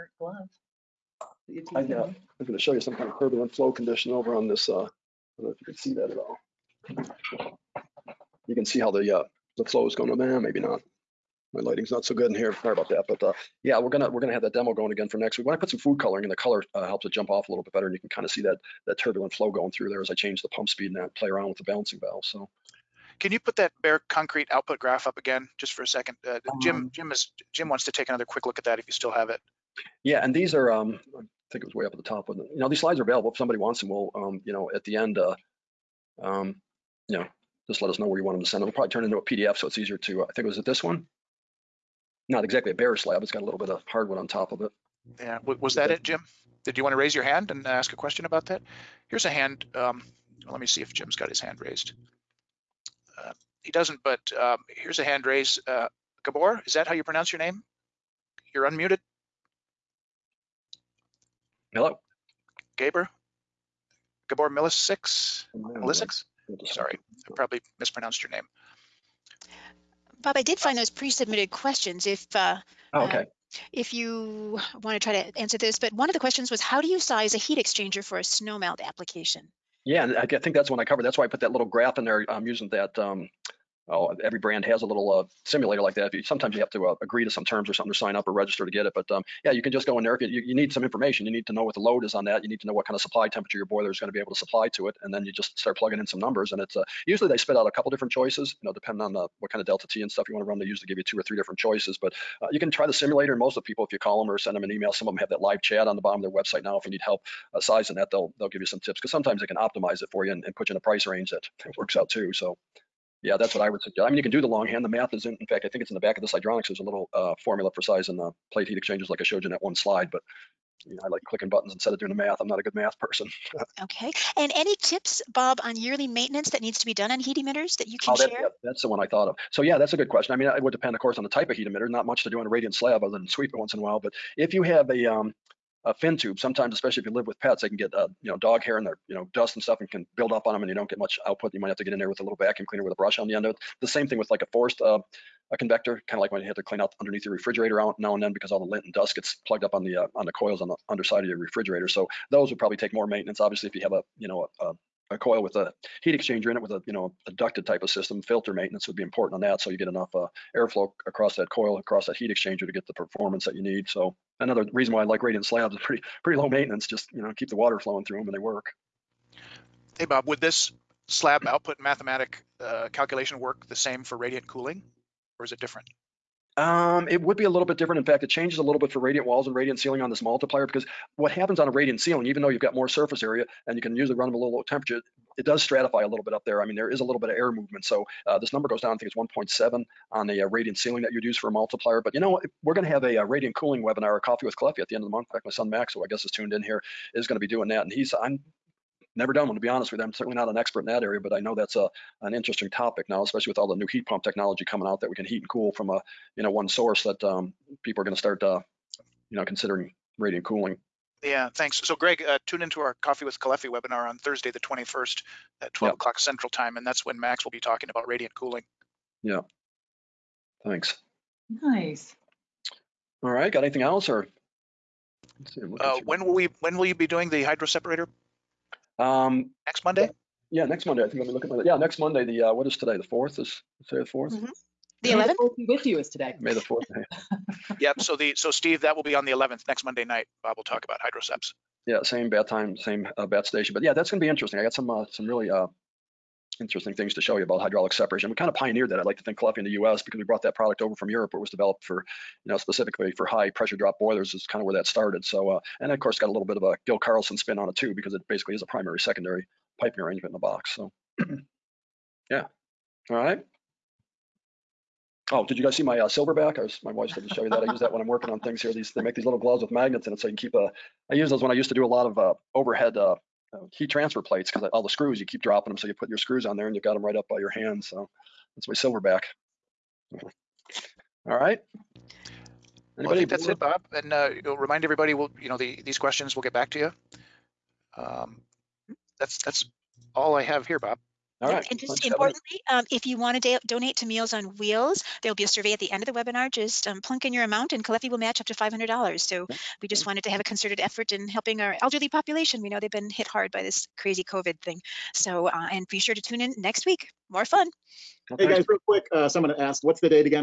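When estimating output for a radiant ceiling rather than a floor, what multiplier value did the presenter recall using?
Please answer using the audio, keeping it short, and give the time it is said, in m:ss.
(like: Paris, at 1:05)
1.7, at 3:09.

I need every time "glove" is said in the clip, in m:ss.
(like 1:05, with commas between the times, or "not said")
0:00, 4:29.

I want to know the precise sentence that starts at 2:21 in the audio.
You might have to get in there with a little vacuum cleaner with a brush on the end of it.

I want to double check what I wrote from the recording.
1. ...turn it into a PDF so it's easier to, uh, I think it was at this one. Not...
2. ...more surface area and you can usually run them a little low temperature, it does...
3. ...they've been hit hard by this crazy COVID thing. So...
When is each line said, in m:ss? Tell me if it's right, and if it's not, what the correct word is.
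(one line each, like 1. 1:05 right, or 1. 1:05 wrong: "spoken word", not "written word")
1. 0:38 right
2. 3:02 right
3. 5:02 right.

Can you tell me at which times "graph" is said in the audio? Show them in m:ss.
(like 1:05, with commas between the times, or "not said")
0:24, 1:21.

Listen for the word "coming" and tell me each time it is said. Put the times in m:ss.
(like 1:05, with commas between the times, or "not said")
3:24.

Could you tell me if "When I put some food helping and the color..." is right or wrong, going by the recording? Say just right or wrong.
wrong.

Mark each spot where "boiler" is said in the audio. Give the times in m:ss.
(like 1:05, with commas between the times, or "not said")
1:33, 4:13.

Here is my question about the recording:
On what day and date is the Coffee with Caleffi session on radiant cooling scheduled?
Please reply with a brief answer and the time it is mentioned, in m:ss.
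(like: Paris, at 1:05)
Thursday, the 21st, at 3:34.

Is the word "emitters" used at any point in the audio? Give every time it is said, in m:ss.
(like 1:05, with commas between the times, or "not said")
2:07, 2:11.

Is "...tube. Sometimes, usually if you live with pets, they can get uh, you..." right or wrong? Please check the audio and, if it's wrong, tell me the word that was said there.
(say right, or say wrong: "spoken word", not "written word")
wrong: "especially", not "usually".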